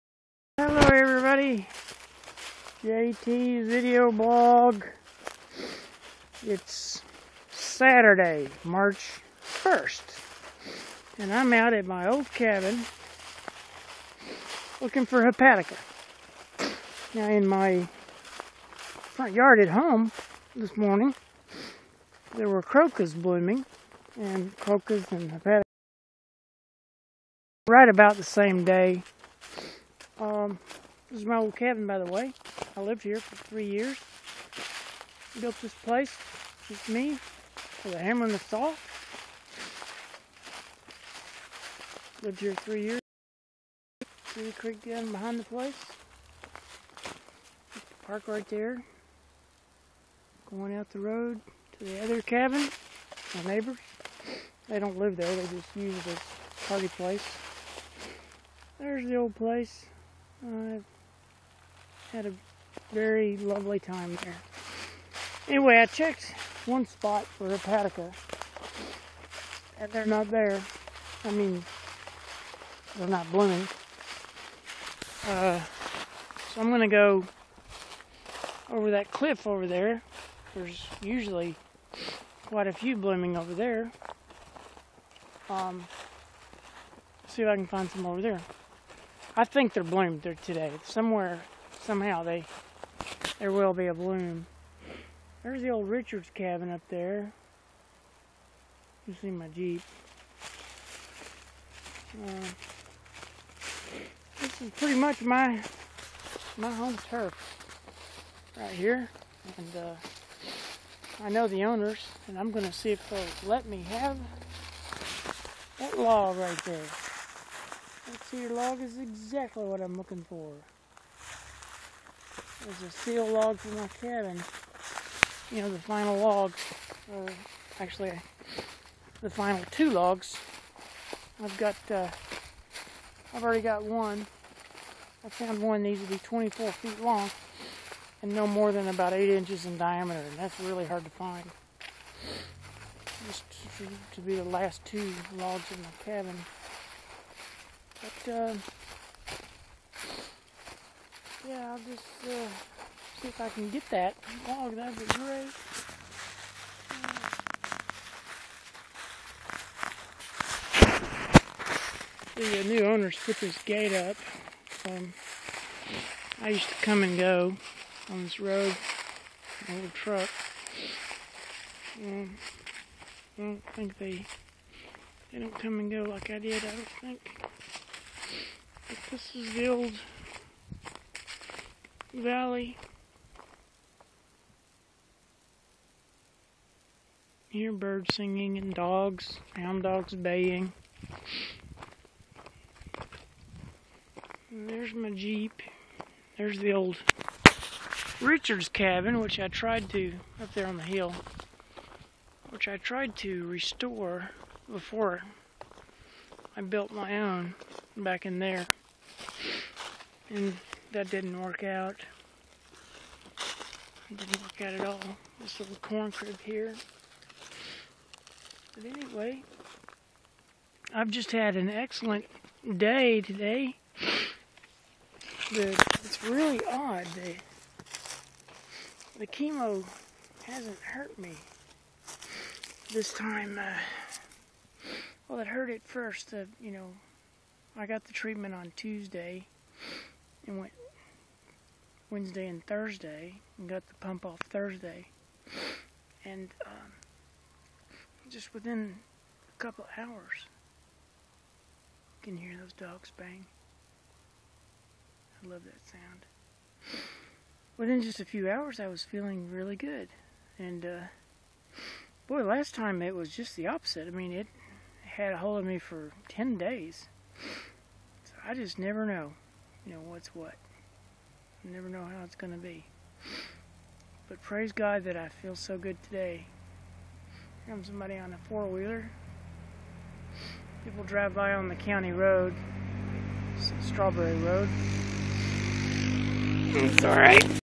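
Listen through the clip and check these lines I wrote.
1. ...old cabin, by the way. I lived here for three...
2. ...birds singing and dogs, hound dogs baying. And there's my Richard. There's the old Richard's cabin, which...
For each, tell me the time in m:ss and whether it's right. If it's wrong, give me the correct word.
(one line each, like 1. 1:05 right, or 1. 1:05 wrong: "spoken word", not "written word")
1. 0:31 right
2. 3:07 wrong: "Jeep", not "Richard".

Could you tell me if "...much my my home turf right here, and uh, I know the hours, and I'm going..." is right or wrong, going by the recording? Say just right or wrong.
wrong.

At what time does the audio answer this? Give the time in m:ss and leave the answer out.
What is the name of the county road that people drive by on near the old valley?
4:43.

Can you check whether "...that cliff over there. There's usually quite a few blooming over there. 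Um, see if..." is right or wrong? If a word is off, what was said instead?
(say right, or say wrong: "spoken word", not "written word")
right.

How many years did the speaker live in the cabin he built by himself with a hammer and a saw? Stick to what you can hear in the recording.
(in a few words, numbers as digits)
3.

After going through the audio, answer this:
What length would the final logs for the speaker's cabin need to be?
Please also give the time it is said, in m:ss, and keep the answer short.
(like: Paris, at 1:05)
24 feet, at 2:16.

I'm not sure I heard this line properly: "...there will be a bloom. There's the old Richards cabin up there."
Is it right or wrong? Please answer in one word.
right.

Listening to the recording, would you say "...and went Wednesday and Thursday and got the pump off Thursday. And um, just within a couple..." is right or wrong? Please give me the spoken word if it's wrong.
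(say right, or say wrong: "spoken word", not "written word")
right.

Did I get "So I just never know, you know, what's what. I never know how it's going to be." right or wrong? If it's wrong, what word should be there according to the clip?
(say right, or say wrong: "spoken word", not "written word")
right.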